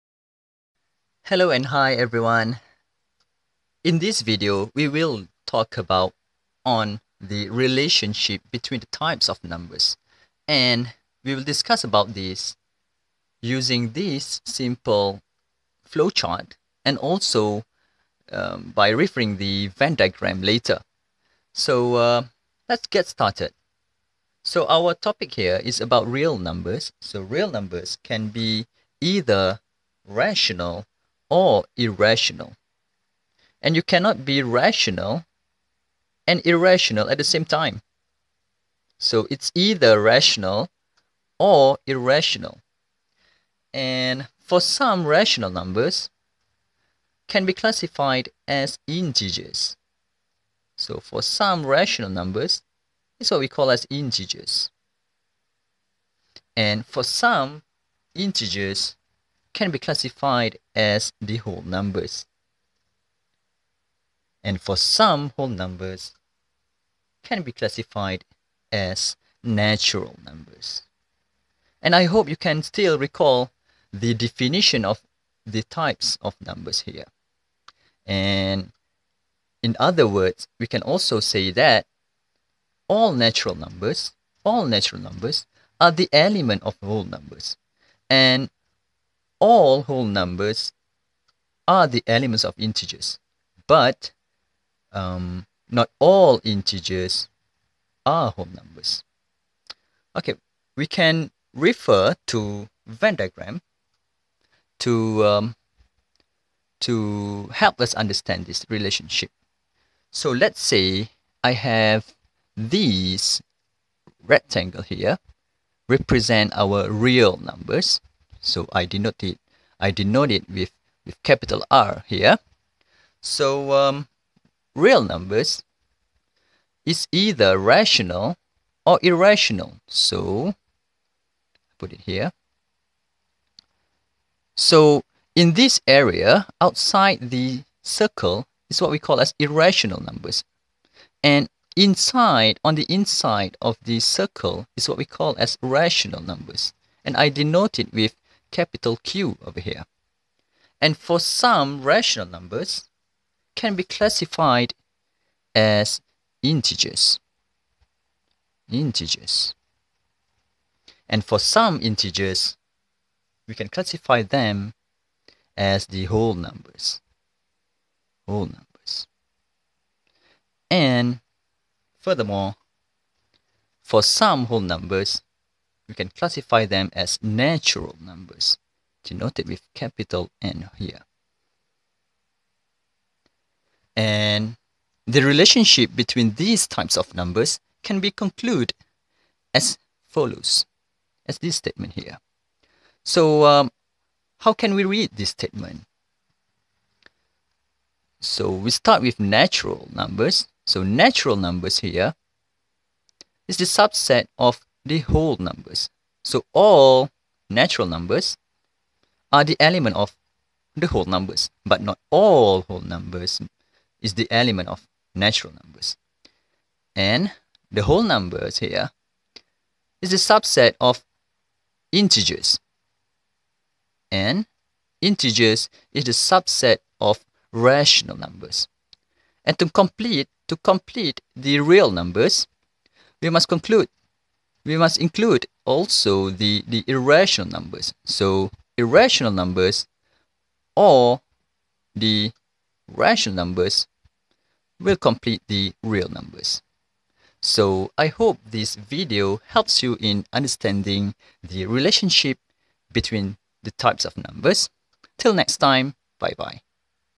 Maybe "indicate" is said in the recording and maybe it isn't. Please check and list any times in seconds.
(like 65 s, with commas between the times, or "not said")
not said.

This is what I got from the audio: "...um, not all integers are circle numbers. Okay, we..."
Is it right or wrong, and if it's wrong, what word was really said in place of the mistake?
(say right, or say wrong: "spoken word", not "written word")
wrong: "whole", not "circle".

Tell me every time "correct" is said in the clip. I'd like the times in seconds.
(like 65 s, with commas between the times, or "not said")
not said.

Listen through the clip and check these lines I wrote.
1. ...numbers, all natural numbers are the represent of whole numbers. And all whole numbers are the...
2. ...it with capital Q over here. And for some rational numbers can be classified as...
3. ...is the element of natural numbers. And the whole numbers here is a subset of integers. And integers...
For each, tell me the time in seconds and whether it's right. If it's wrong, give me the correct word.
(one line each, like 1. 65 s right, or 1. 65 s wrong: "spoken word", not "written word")
1. 83 s wrong: "element", not "represent"
2. 147 s right
3. 214 s right.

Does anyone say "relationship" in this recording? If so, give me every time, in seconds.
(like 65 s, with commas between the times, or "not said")
7 s, 108 s, 185 s, 251 s.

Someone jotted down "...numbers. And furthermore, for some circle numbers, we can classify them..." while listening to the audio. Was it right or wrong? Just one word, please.
wrong.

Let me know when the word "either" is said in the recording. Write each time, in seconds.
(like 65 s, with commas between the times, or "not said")
29 s, 39 s, 127 s.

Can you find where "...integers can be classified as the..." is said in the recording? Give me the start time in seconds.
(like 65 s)
58 s.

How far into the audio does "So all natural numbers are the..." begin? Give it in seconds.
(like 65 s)
206 s.